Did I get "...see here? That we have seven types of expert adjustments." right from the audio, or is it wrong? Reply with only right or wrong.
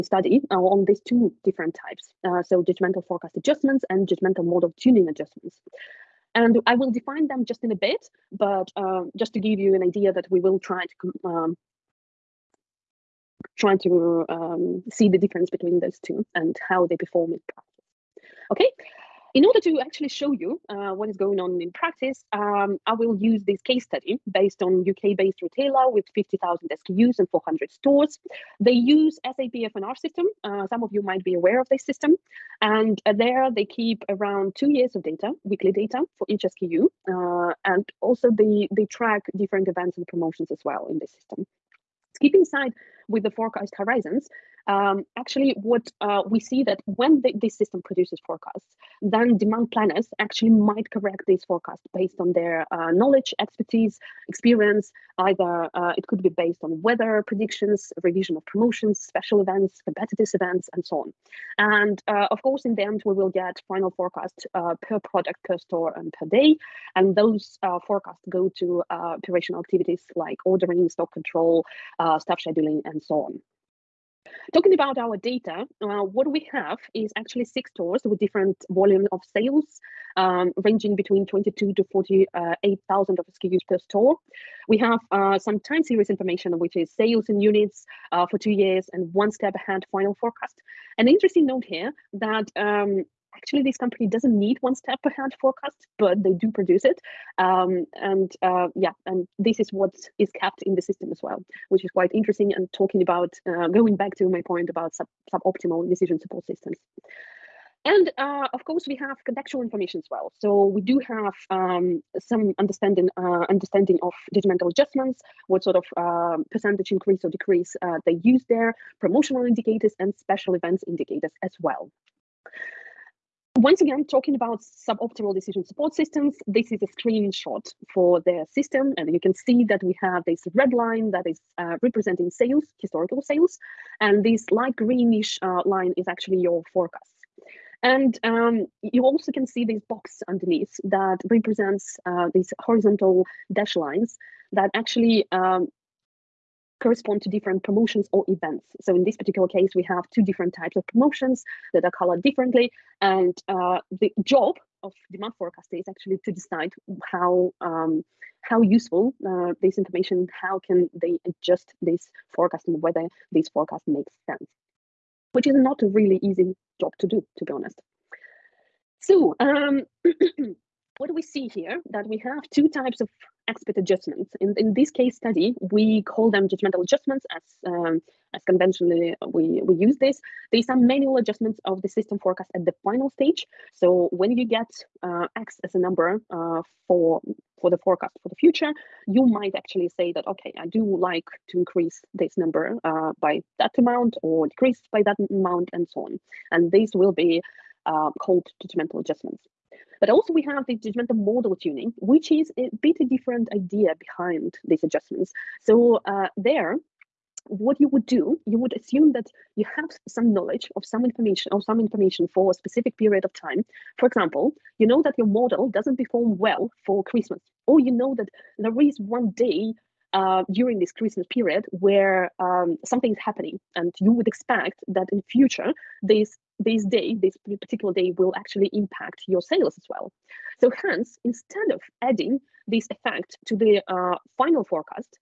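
wrong.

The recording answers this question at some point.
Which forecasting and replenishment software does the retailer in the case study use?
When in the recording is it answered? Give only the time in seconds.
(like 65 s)
29 s.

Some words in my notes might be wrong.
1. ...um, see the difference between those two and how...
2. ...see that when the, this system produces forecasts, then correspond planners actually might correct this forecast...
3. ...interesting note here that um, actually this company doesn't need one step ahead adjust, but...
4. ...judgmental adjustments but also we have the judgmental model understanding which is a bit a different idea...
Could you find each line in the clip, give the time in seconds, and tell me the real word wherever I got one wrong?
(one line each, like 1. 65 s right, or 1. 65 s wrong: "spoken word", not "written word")
1. 14 s right
2. 46 s wrong: "demand", not "correspond"
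3. 91 s wrong: "forecast", not "adjust"
4. 198 s wrong: "tuning", not "understanding".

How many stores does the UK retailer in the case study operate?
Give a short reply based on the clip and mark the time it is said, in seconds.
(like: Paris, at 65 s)
400, at 27 s.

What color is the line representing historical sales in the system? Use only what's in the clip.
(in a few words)
red.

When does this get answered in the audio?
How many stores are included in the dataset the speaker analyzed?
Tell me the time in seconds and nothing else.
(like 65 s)
77 s.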